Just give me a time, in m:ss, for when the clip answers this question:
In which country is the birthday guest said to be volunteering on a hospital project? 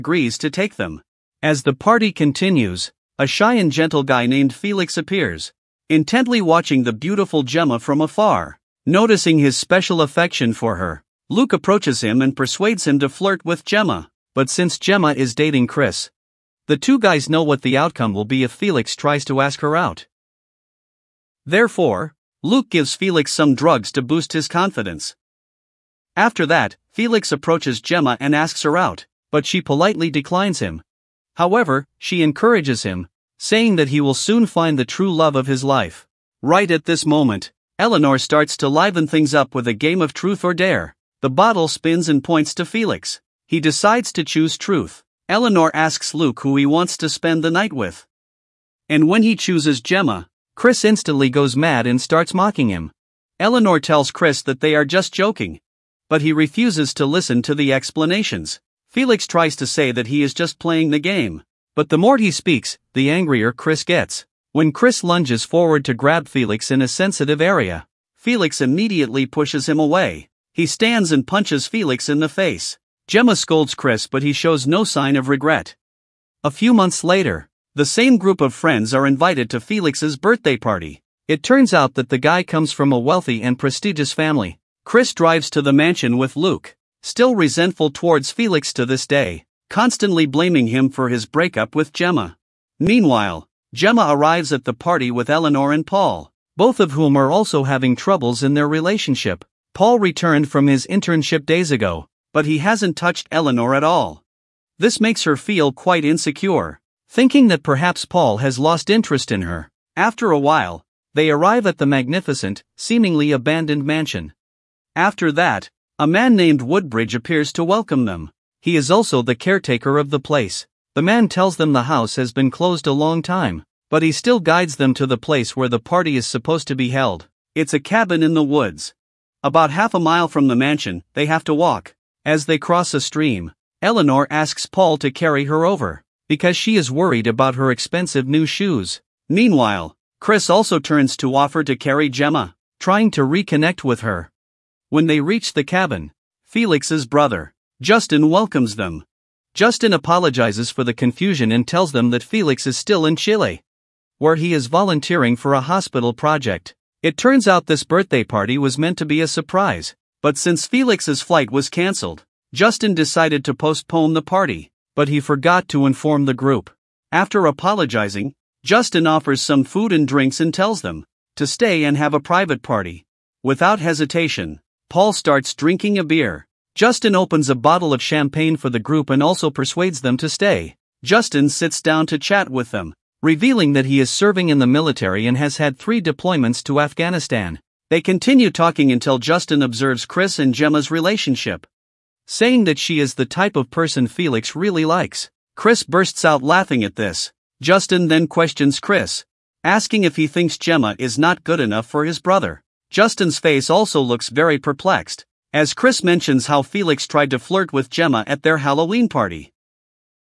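2:33.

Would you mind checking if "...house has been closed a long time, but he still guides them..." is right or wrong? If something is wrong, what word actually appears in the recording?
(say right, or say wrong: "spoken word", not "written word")
right.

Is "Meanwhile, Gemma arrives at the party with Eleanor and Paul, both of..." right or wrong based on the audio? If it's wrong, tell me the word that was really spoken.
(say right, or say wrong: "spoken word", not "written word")
right.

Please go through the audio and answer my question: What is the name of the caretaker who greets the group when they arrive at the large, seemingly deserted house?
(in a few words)
Woodbridge.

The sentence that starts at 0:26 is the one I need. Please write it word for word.
After that, Felix approaches Gemma and asks her out, but she politely declines him.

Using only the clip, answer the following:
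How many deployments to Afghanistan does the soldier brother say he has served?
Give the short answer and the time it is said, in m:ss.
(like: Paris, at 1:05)
3, at 3:05.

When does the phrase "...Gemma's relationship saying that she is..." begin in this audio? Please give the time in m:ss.
3:10.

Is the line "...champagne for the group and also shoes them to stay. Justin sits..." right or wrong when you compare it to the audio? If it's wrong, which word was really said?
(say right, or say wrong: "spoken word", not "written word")
wrong: "persuades", not "shoes".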